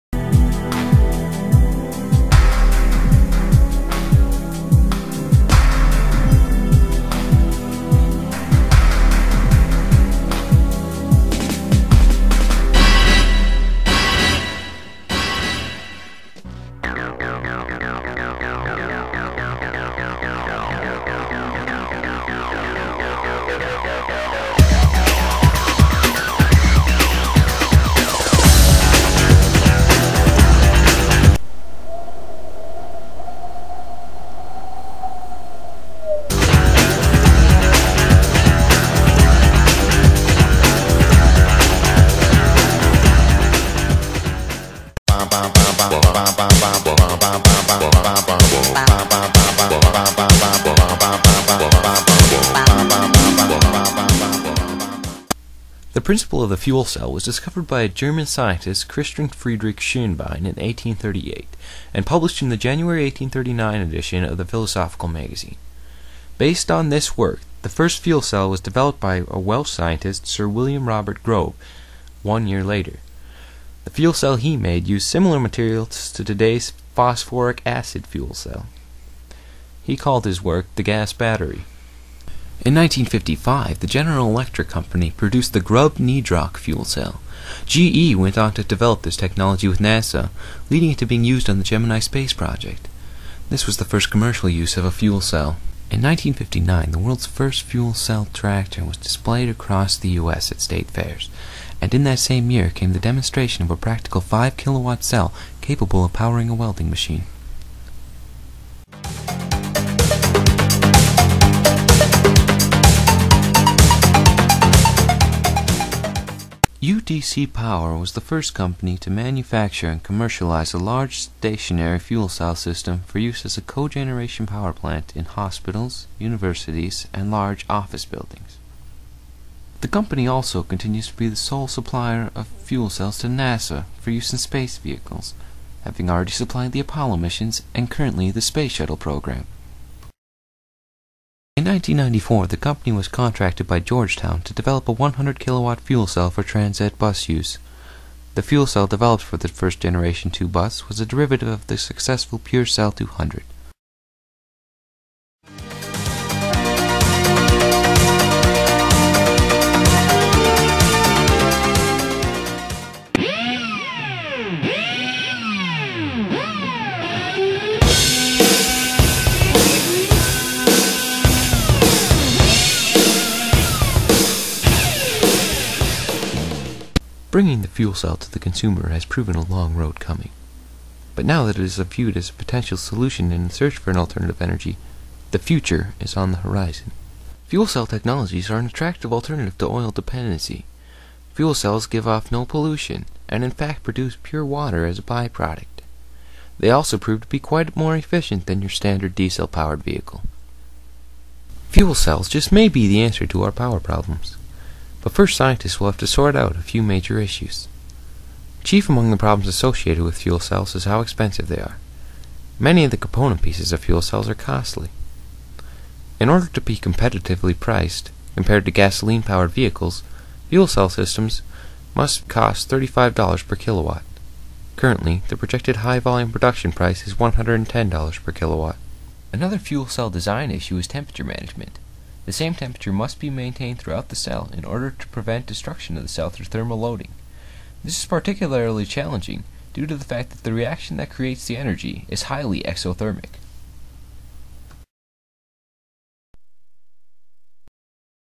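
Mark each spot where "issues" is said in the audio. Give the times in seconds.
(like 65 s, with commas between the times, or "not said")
207 s, 230 s.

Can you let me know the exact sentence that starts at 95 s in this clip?
In 1959, the world's first fuel cell tractor was displayed across the U.S.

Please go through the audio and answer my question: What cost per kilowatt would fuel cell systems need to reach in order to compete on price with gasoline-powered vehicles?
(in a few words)
$35.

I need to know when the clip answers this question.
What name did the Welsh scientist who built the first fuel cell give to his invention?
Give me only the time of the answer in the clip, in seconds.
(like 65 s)
80 s.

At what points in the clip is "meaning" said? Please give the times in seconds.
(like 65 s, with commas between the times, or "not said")
not said.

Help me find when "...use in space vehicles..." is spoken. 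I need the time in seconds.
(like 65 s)
134 s.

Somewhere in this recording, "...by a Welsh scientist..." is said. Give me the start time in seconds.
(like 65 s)
69 s.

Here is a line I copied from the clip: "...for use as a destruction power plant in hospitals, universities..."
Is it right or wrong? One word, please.
wrong.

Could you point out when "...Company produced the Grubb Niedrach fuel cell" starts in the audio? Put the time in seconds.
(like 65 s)
84 s.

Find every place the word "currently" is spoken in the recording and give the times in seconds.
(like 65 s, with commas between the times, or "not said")
137 s, 224 s.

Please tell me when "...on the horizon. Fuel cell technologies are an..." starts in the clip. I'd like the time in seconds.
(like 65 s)
186 s.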